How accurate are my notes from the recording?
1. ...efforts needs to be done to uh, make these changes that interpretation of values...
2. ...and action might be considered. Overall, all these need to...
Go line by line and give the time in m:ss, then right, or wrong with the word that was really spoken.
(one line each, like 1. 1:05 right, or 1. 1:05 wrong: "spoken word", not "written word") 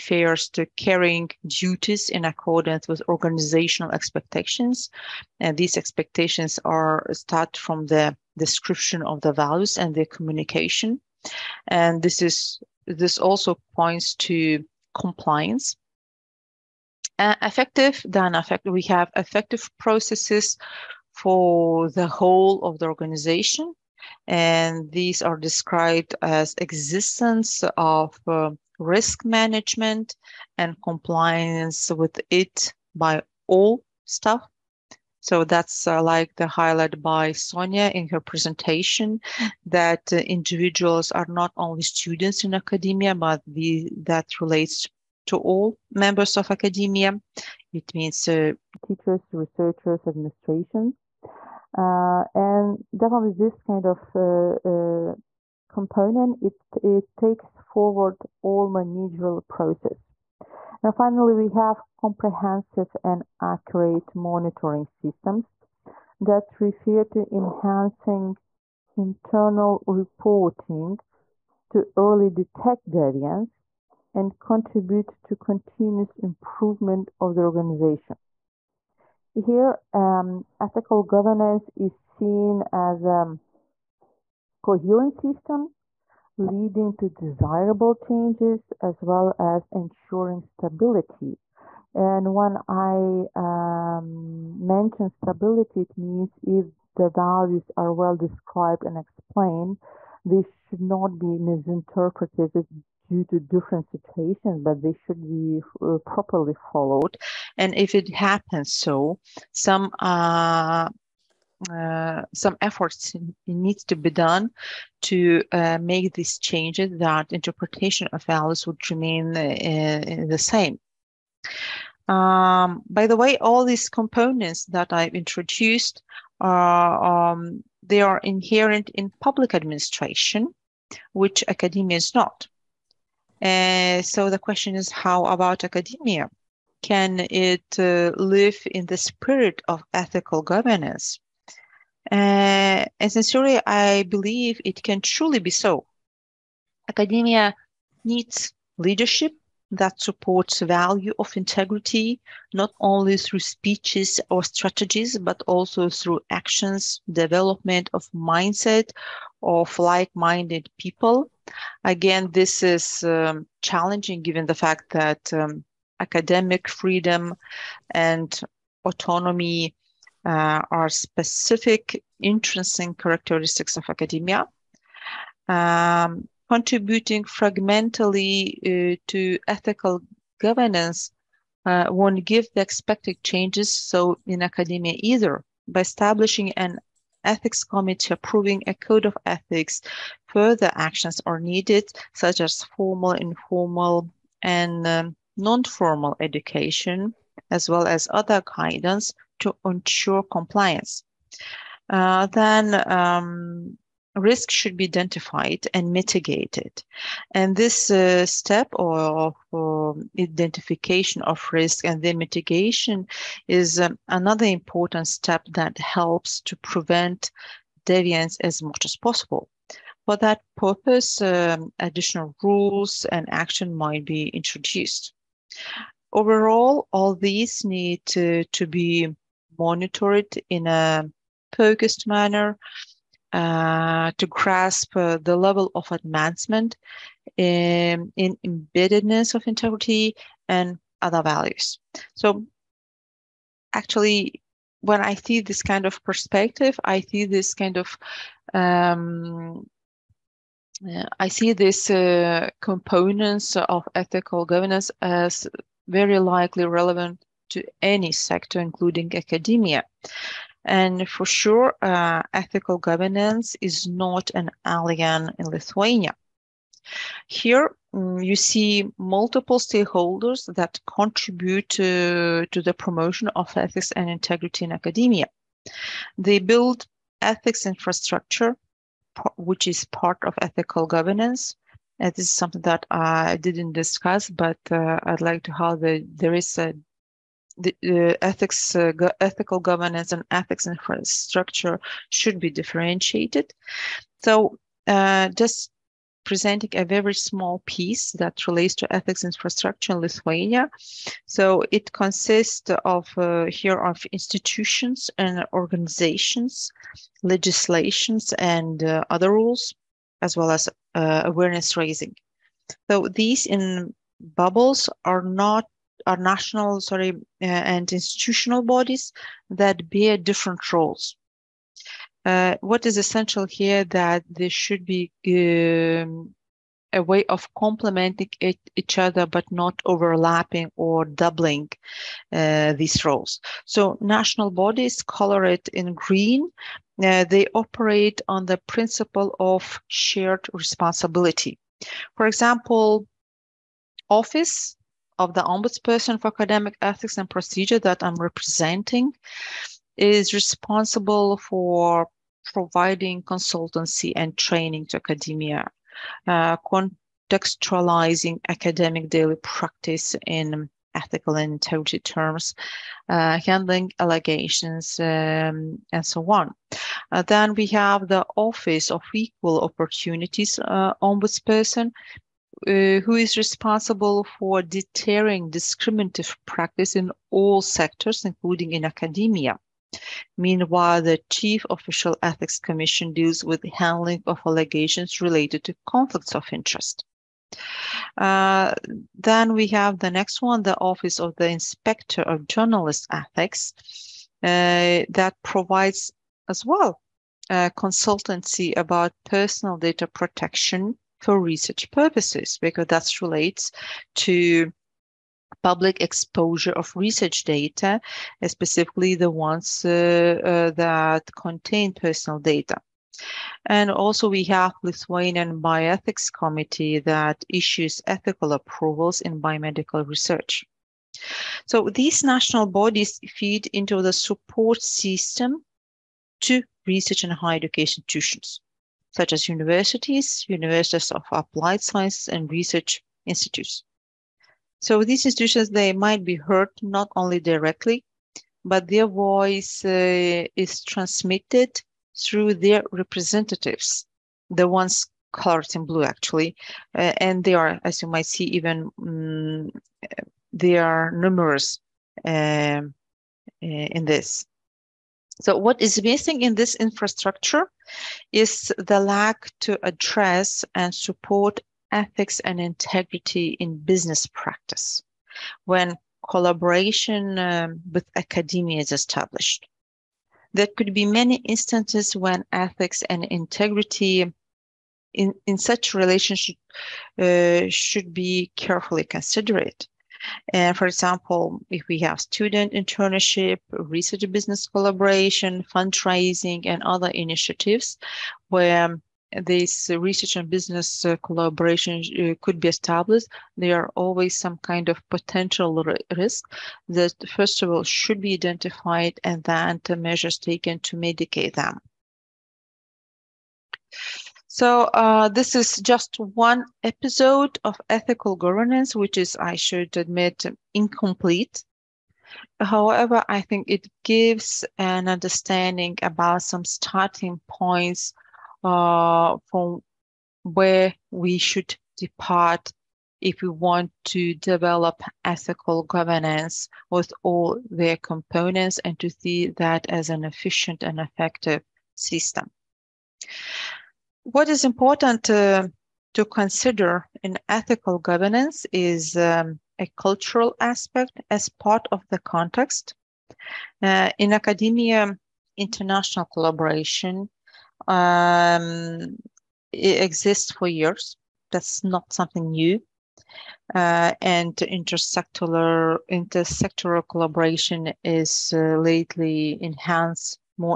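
1. 1:52 right
2. 3:43 wrong: "introduced", not "considered".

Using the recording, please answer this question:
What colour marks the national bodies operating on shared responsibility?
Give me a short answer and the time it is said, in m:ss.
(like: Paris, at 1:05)
green, at 5:35.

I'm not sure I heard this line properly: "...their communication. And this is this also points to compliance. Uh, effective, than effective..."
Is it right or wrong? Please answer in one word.
right.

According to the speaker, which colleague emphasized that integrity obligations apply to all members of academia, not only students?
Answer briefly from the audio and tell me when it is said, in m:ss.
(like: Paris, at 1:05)
Sonia, at 0:37.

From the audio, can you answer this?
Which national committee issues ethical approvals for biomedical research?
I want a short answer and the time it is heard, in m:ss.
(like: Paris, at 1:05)
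Lithuanian Bioethics Committee, at 6:54.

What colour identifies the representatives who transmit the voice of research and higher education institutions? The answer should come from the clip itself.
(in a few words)
blue.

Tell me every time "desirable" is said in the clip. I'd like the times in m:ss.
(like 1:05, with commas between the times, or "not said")
1:27.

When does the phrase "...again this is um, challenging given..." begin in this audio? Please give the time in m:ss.
2:41.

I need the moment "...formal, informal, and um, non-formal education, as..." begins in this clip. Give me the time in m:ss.
3:12.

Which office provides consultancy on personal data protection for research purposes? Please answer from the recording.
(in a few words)
Office of the Inspector of Journalist Ethics.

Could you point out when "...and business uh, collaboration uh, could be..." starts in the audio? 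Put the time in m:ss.
8:10.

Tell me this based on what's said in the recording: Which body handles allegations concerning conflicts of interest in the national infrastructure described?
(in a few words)
Chief Official Ethics Commission.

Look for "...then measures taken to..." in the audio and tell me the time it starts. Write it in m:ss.
8:19.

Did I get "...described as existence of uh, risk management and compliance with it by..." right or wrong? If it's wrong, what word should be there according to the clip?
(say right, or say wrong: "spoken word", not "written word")
right.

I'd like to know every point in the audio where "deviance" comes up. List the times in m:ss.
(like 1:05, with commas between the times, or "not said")
1:12, 3:37.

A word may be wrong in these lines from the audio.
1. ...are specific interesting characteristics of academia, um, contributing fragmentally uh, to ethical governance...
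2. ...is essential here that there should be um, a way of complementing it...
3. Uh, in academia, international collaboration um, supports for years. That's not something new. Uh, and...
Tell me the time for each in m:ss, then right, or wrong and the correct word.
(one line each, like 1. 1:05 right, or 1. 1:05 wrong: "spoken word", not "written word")
1. 2:50 right
2. 5:22 right
3. 9:03 wrong: "exists", not "supports".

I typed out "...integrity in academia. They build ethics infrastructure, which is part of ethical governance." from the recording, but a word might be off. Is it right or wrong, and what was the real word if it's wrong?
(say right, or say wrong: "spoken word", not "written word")
right.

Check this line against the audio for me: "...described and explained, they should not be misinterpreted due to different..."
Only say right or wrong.
right.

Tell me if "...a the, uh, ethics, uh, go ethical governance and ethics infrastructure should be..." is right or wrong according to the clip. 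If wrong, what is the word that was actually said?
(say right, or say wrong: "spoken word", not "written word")
right.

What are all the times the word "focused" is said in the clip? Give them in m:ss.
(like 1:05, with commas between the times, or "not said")
3:51.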